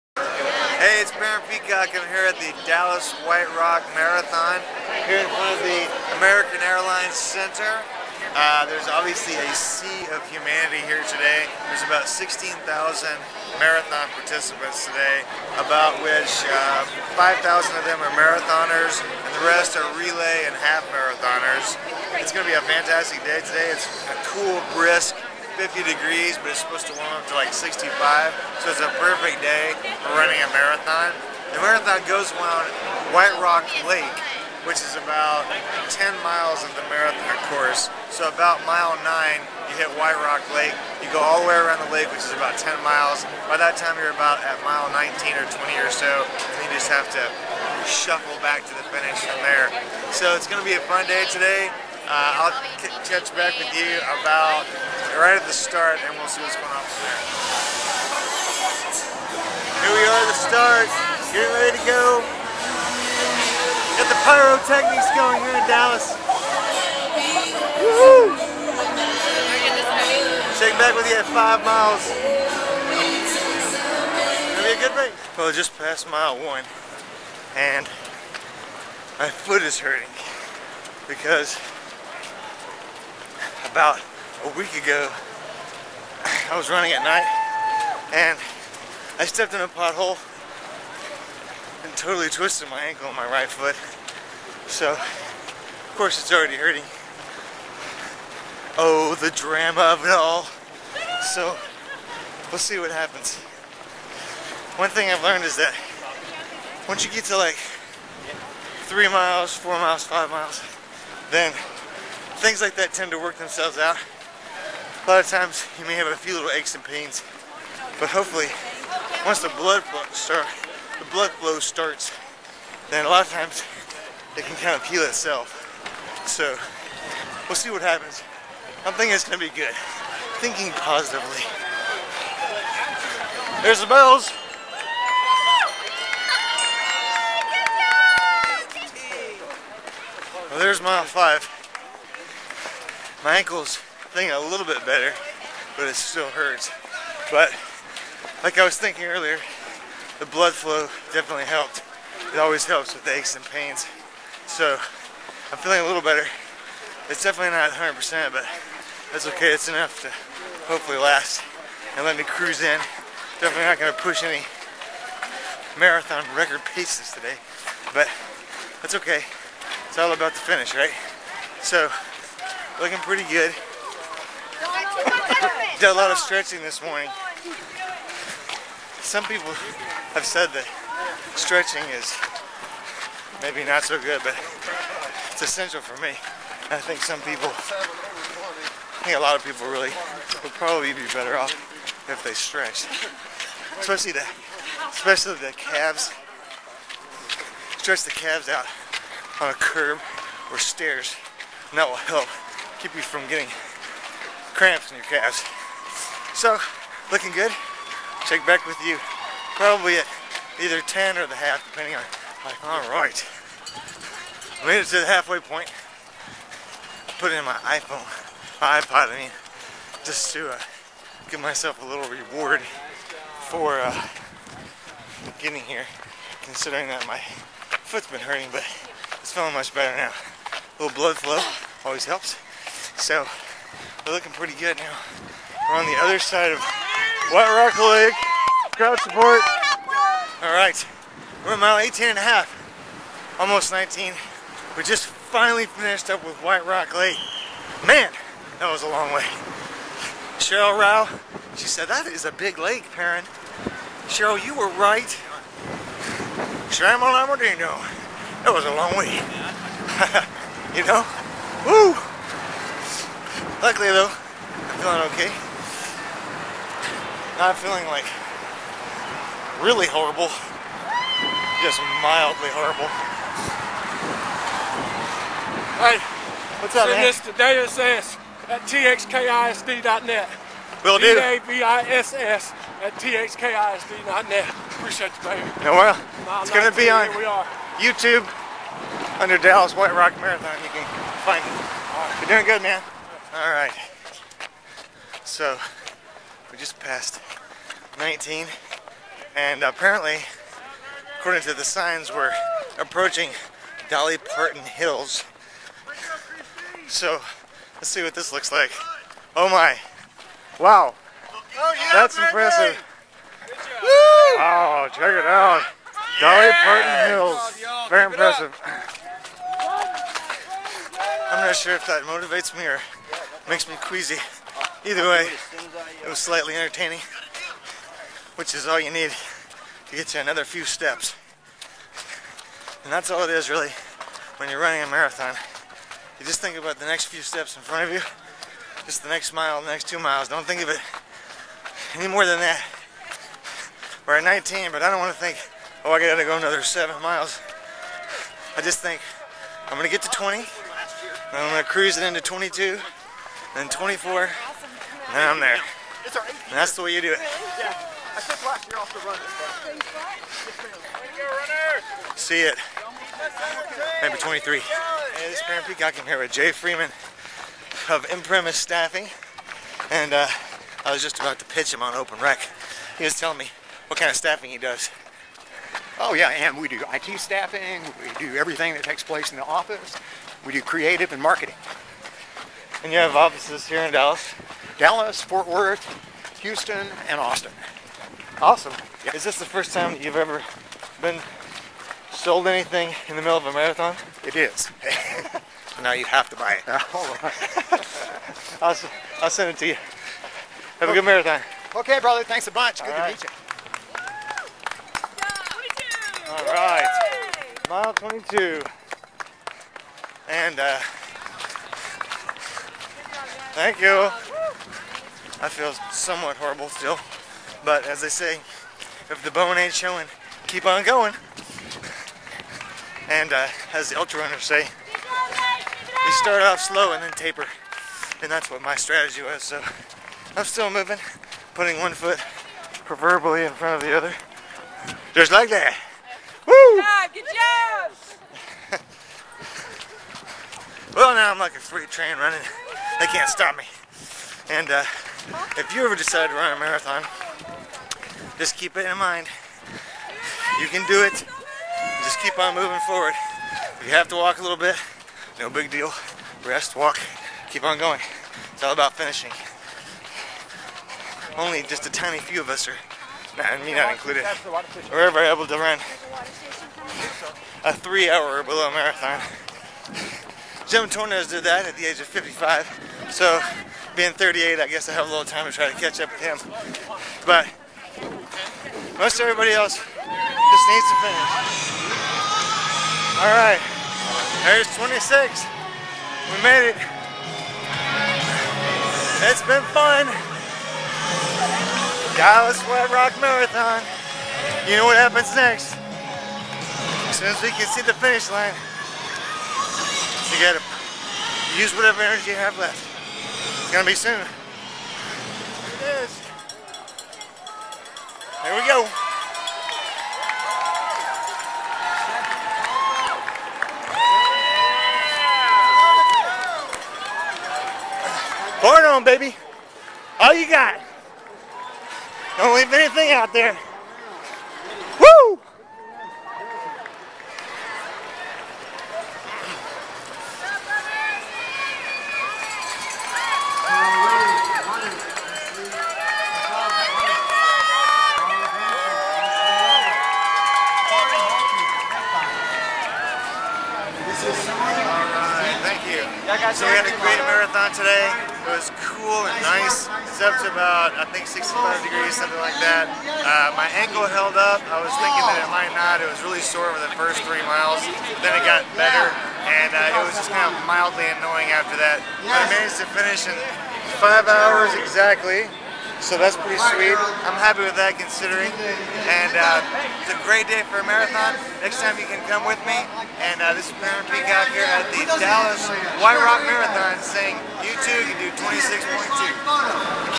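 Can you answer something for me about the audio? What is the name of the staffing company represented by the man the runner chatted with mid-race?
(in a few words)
Imprimis Staffing.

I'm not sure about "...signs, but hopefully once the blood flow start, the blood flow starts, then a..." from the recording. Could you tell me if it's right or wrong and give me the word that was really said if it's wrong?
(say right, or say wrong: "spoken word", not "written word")
wrong: "pains", not "signs".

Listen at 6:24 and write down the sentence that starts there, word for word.
Dallas, Fort Worth, Houston, and Austin.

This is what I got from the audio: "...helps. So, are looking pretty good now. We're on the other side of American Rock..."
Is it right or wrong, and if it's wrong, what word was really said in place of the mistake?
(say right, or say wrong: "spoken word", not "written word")
wrong: "White", not "American".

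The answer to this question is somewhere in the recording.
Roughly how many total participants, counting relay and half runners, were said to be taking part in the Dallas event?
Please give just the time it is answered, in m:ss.
0:12.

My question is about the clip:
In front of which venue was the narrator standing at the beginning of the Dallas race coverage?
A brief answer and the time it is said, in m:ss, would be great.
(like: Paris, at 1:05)
American Airlines Center, at 0:06.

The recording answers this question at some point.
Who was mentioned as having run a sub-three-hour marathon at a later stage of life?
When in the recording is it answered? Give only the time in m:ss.
7:50.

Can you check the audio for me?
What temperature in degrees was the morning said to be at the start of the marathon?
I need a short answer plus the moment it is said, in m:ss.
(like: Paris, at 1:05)
50, at 0:25.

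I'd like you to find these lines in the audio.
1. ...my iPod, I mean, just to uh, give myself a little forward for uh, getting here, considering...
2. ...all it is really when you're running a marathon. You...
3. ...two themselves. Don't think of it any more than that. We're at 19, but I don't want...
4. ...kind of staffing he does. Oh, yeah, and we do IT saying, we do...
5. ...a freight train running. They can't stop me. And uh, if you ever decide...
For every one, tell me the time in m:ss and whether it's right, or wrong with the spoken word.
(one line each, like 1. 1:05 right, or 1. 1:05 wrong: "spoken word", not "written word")
1. 3:38 wrong: "reward", not "forward"
2. 5:33 right
3. 5:39 wrong: "miles", not "themselves"
4. 6:13 wrong: "staffing", not "saying"
5. 7:21 right.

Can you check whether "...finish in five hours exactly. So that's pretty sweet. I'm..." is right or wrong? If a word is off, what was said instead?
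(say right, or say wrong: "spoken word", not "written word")
right.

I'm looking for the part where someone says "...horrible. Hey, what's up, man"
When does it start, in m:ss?
4:32.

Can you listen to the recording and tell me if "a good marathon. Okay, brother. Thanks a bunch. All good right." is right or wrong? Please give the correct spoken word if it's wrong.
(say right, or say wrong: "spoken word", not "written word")
right.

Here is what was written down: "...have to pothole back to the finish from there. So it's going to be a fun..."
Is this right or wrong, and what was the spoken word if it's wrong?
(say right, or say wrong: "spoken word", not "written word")
wrong: "shuffle", not "pothole".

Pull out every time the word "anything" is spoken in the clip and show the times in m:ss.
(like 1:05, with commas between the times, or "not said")
6:32, 8:42.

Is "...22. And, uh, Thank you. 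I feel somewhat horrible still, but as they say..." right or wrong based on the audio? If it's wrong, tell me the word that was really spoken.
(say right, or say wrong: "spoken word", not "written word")
right.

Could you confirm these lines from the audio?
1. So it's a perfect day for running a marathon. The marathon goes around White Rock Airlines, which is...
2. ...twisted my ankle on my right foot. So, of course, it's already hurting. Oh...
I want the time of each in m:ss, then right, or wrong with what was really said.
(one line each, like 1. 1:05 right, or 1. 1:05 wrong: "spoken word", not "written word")
1. 0:28 wrong: "Lake", not "Airlines"
2. 1:32 right.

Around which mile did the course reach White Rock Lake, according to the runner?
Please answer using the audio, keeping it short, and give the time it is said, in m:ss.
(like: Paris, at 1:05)
9, at 0:38.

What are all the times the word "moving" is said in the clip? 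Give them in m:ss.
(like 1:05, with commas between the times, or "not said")
7:10, 7:32.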